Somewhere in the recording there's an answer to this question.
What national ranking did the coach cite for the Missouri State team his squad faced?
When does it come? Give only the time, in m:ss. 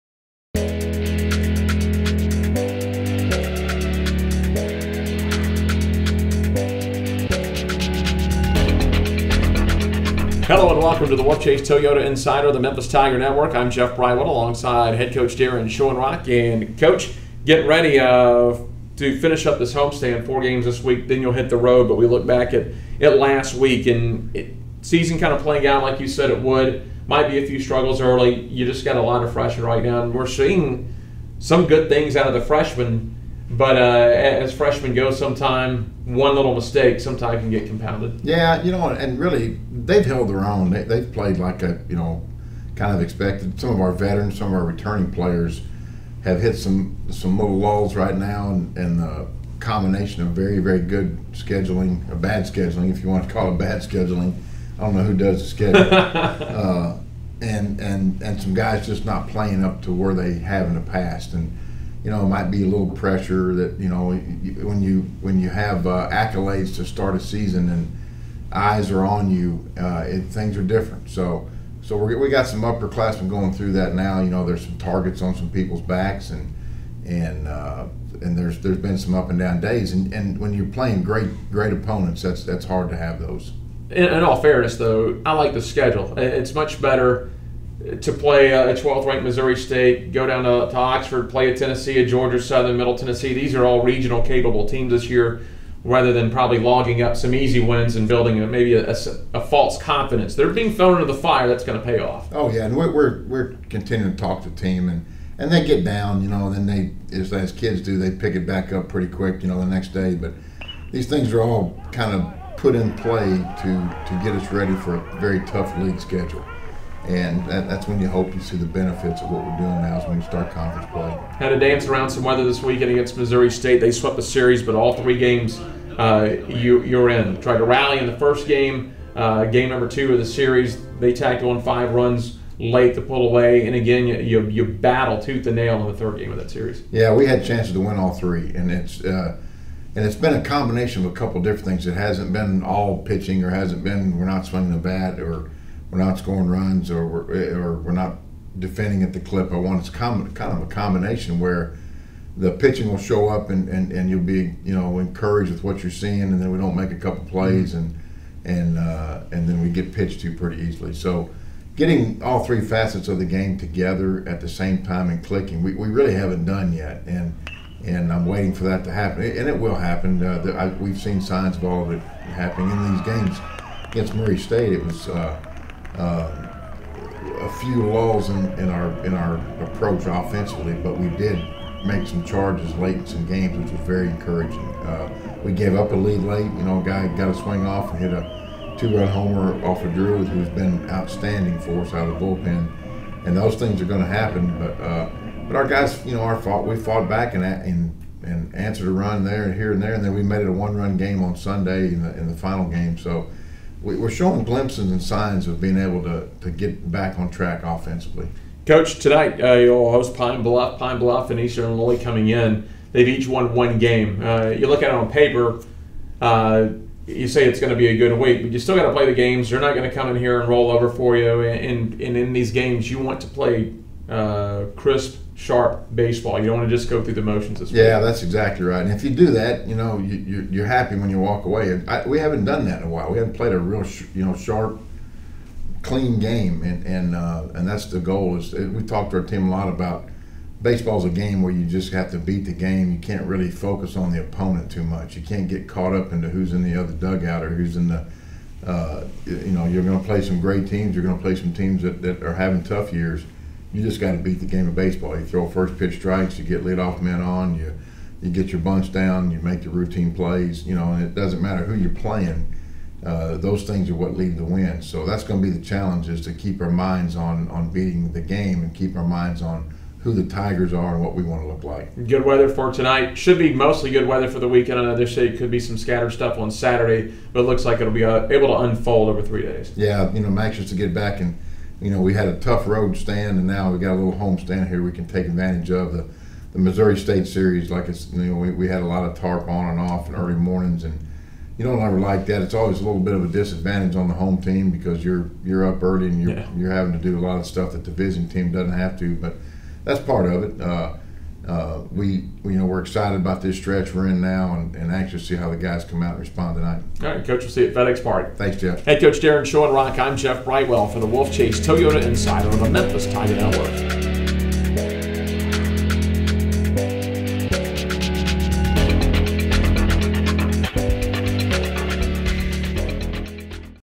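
1:28.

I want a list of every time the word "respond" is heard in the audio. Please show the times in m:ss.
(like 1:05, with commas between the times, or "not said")
5:06.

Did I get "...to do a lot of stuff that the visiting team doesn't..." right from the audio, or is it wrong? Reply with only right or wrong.
right.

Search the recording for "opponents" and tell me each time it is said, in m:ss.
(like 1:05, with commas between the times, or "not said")
1:21, 4:04.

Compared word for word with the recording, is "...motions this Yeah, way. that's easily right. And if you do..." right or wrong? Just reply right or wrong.
wrong.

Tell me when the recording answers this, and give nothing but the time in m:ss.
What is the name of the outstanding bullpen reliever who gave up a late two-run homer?
3:09.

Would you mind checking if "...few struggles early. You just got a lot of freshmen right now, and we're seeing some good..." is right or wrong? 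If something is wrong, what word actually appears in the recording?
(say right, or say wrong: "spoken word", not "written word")
right.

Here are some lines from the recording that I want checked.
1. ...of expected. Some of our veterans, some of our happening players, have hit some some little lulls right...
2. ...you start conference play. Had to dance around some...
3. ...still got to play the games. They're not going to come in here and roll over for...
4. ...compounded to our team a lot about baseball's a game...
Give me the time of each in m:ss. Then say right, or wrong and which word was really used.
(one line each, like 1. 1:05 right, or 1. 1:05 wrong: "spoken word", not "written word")
1. 0:42 wrong: "returning", not "happening"
2. 2:00 right
3. 3:38 right
4. 3:58 wrong: "talked", not "compounded".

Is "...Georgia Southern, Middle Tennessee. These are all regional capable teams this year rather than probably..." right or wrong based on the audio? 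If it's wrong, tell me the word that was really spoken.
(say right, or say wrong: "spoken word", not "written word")
right.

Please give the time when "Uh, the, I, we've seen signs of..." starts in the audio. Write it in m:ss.
2:50.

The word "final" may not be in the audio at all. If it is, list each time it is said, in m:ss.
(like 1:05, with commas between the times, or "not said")
3:22.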